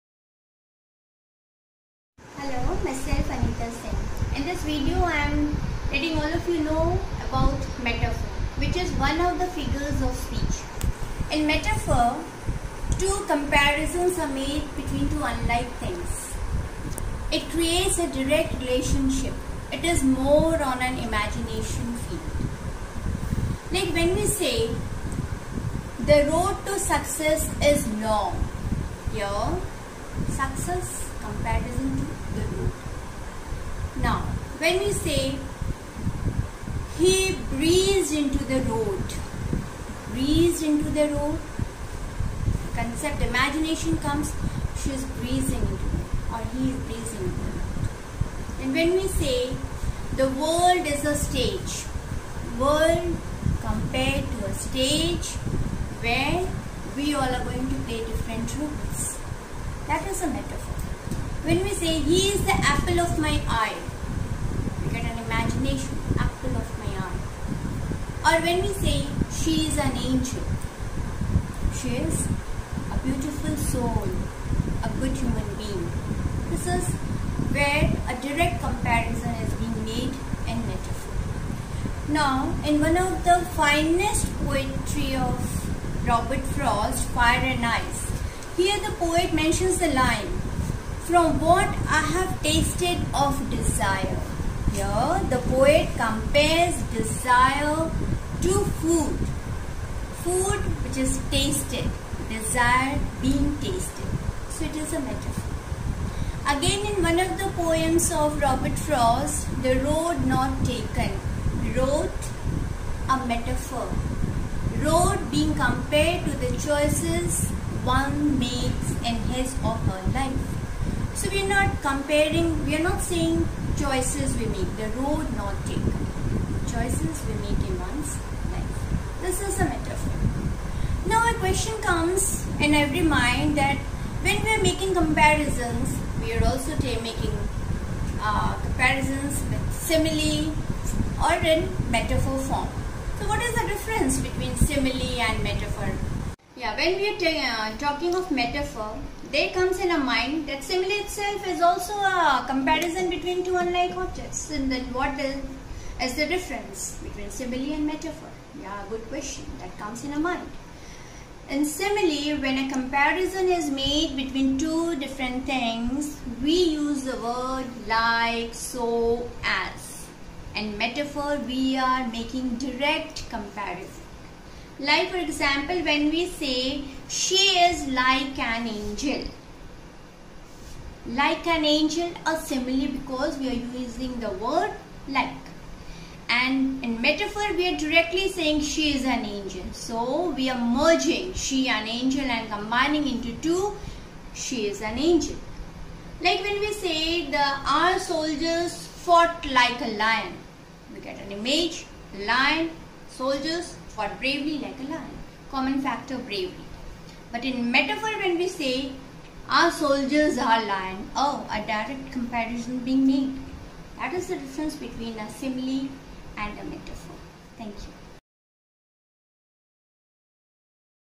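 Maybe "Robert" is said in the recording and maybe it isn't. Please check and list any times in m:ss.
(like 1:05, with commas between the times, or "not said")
1:26, 1:48.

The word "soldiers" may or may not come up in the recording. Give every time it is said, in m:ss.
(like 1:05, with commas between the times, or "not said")
3:17, 3:23, 3:29.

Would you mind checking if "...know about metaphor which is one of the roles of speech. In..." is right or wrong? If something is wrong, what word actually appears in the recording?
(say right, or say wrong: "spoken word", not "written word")
wrong: "figures", not "roles".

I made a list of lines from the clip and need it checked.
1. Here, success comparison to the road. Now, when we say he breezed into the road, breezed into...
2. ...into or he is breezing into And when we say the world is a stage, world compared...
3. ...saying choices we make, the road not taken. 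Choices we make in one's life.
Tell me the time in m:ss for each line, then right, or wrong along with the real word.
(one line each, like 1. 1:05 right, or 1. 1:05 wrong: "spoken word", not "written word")
1. 0:29 right
2. 0:45 right
3. 2:02 right.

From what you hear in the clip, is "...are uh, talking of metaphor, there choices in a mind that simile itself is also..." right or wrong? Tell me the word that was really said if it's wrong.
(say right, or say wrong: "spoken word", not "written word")
wrong: "comes", not "choices".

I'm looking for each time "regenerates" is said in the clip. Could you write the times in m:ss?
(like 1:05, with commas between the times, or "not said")
not said.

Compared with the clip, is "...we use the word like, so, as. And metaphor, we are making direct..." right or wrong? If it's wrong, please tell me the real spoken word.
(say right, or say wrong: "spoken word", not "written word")
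right.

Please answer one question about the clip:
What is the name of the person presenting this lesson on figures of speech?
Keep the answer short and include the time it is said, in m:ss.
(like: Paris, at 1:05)
Anita Sen, at 0:03.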